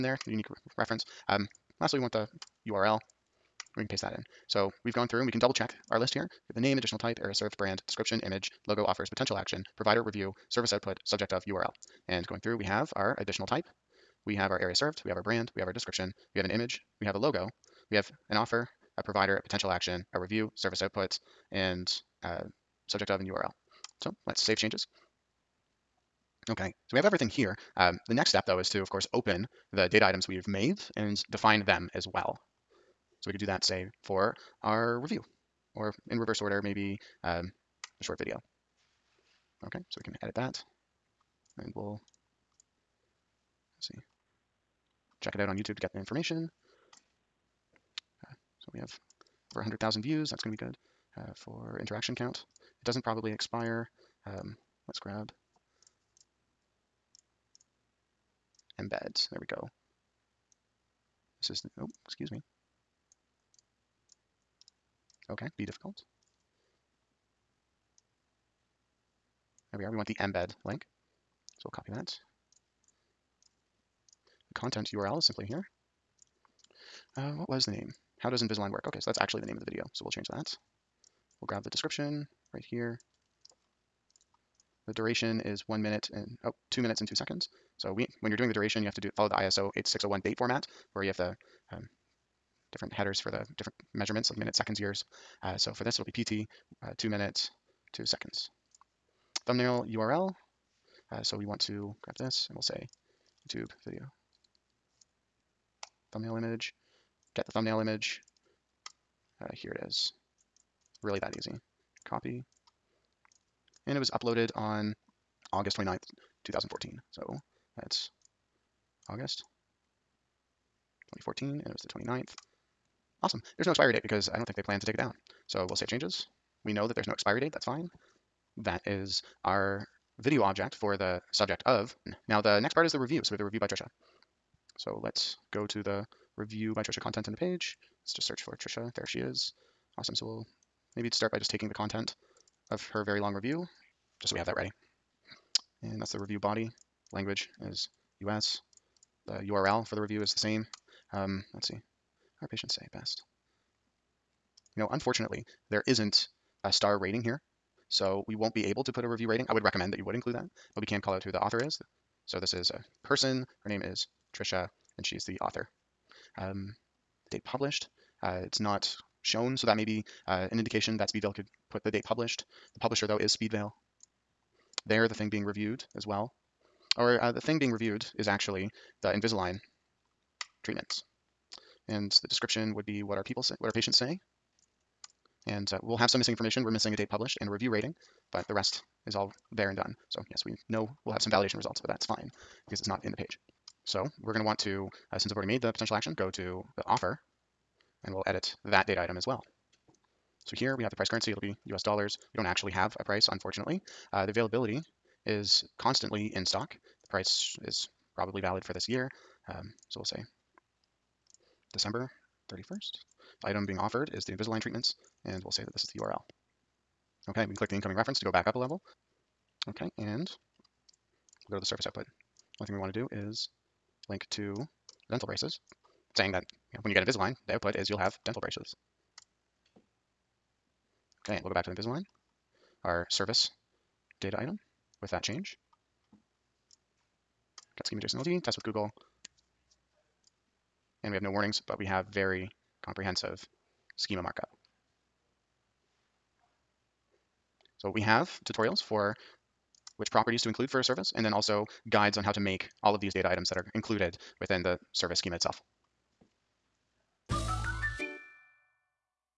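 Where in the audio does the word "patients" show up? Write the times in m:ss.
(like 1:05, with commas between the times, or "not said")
2:32, 3:03.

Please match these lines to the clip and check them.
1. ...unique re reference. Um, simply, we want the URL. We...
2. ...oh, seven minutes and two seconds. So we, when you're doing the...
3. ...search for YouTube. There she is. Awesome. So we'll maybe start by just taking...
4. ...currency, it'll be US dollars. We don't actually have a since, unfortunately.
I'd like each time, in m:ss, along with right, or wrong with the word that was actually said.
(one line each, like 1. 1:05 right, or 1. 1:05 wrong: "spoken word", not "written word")
1. 0:00 wrong: "lastly", not "simply"
2. 1:26 wrong: "two", not "seven"
3. 2:18 wrong: "Trisha", not "YouTube"
4. 3:21 wrong: "price", not "since".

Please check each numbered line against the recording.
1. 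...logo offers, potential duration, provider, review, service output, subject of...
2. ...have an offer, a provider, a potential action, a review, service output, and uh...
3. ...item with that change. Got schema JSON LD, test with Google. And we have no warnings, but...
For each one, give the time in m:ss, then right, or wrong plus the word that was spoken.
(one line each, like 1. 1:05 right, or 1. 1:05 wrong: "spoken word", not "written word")
1. 0:08 wrong: "action", not "duration"
2. 0:17 right
3. 3:54 right.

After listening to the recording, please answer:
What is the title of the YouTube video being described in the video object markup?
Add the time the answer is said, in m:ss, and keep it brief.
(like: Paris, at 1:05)
How does Invisalign work?, at 1:18.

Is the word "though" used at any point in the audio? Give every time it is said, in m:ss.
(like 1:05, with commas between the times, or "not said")
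0:28, 2:53.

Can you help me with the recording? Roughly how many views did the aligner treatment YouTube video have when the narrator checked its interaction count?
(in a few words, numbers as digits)
over 100,000.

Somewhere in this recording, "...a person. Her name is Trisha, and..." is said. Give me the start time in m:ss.
2:42.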